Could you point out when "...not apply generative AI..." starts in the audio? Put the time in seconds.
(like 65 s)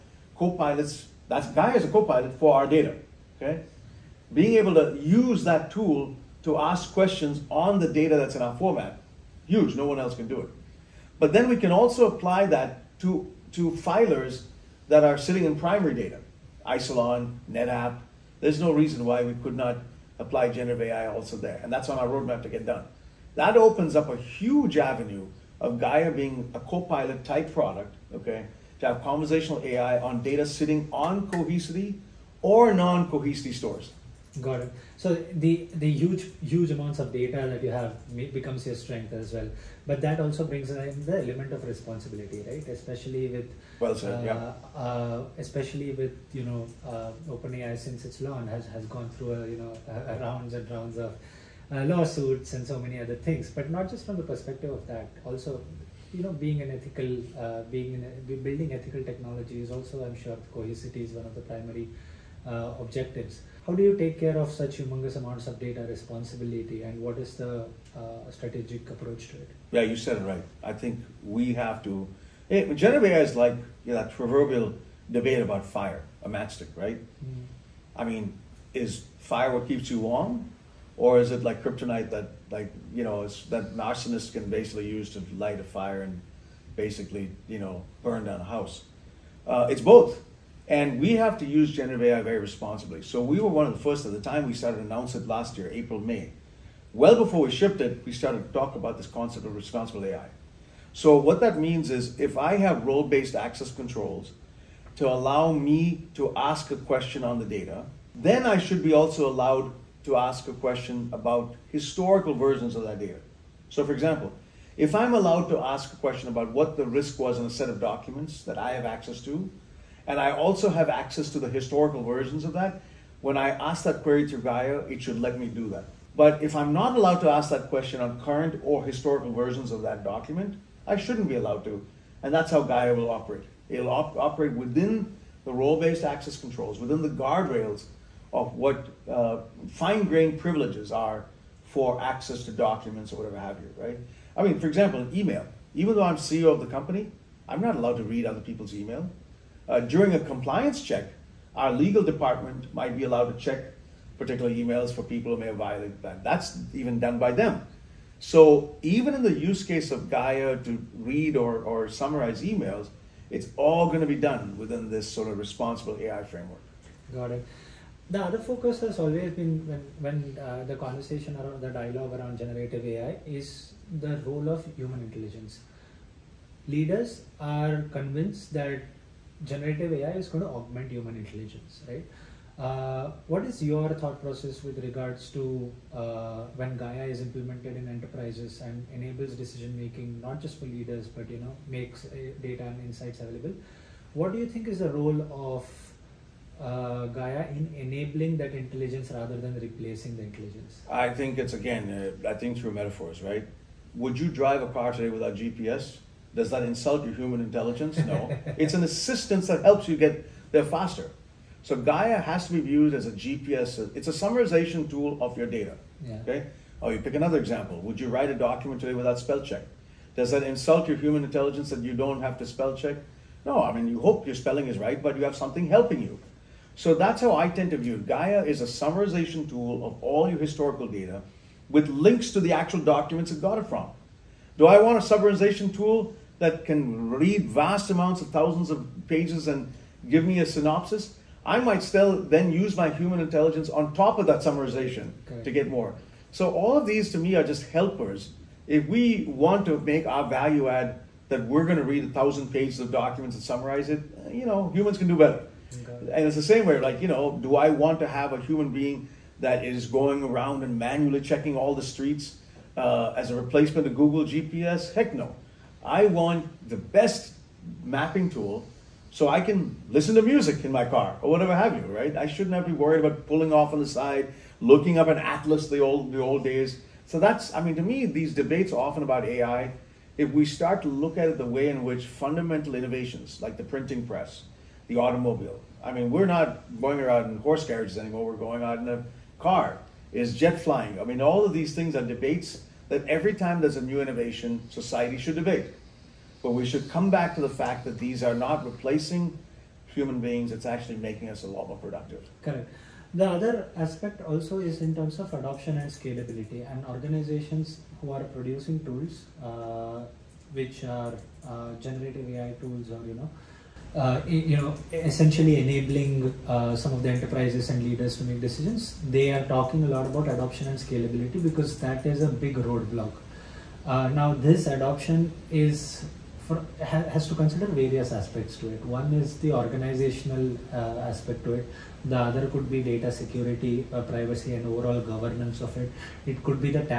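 19 s.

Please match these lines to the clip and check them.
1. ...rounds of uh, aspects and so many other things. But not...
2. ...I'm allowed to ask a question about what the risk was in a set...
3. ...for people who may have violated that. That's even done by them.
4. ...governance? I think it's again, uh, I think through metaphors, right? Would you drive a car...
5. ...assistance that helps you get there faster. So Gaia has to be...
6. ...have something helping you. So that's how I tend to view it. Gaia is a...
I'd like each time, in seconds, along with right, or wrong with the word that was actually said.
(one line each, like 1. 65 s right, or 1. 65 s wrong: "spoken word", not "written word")
1. 50 s wrong: "lawsuits", not "aspects"
2. 114 s right
3. 154 s right
4. 200 s wrong: "intelligence", not "governance"
5. 208 s right
6. 225 s right.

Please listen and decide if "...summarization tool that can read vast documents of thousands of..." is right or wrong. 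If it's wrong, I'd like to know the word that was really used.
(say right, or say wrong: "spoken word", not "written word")
wrong: "amounts", not "documents".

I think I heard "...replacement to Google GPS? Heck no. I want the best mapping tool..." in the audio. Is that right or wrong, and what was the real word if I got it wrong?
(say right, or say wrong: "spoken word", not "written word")
right.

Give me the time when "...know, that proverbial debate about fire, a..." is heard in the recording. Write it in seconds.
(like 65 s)
73 s.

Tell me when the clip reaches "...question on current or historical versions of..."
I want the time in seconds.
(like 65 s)
127 s.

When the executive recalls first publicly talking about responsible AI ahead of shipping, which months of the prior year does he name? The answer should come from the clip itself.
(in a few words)
April, May.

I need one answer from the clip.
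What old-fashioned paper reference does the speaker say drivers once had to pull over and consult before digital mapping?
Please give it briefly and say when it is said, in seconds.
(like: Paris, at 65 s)
an atlas, at 275 s.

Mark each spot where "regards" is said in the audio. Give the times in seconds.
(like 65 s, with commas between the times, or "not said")
184 s.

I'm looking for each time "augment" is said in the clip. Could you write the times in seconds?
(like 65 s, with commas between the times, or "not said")
180 s.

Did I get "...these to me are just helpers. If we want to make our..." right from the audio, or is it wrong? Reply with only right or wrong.
right.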